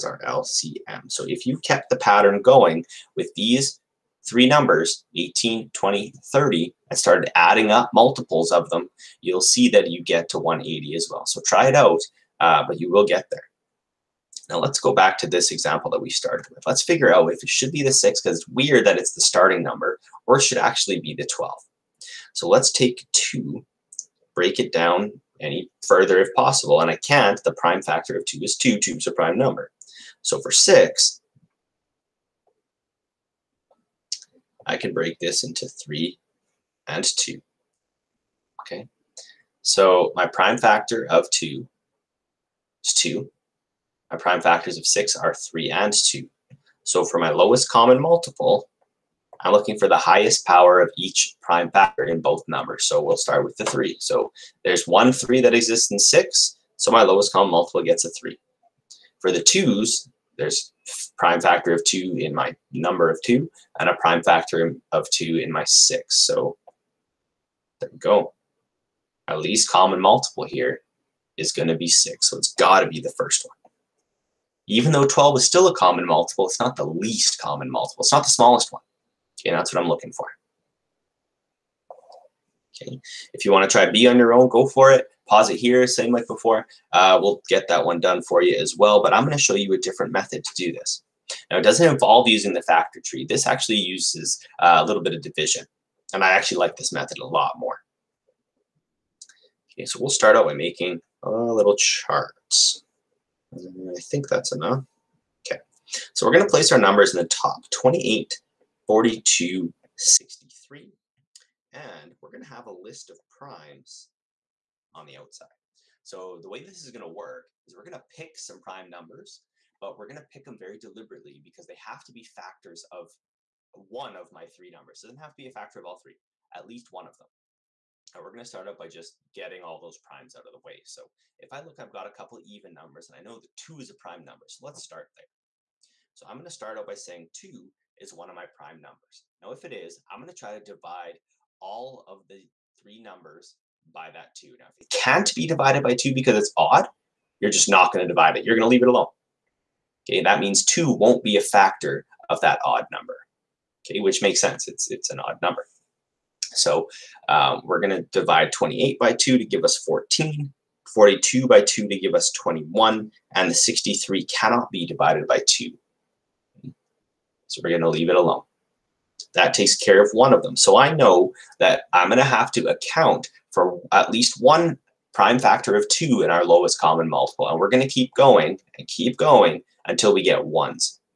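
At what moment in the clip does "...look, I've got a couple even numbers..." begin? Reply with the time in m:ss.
2:11.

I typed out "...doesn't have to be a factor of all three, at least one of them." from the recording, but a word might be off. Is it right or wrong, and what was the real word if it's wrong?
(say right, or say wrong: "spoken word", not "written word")
right.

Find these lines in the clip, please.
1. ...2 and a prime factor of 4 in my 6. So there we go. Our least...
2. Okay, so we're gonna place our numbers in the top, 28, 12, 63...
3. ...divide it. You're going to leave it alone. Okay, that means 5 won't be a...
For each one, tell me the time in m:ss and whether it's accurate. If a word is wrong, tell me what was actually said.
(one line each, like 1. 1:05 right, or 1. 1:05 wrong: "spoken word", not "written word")
1. 1:03 wrong: "2", not "4"
2. 1:45 wrong: "42", not "12"
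3. 2:28 wrong: "2", not "5".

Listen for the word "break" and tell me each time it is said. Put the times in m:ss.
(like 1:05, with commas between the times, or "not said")
0:24, 0:34.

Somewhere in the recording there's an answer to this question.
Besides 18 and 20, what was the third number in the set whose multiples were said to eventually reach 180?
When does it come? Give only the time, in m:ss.
0:06.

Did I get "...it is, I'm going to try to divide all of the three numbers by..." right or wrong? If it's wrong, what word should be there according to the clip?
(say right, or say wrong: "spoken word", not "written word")
right.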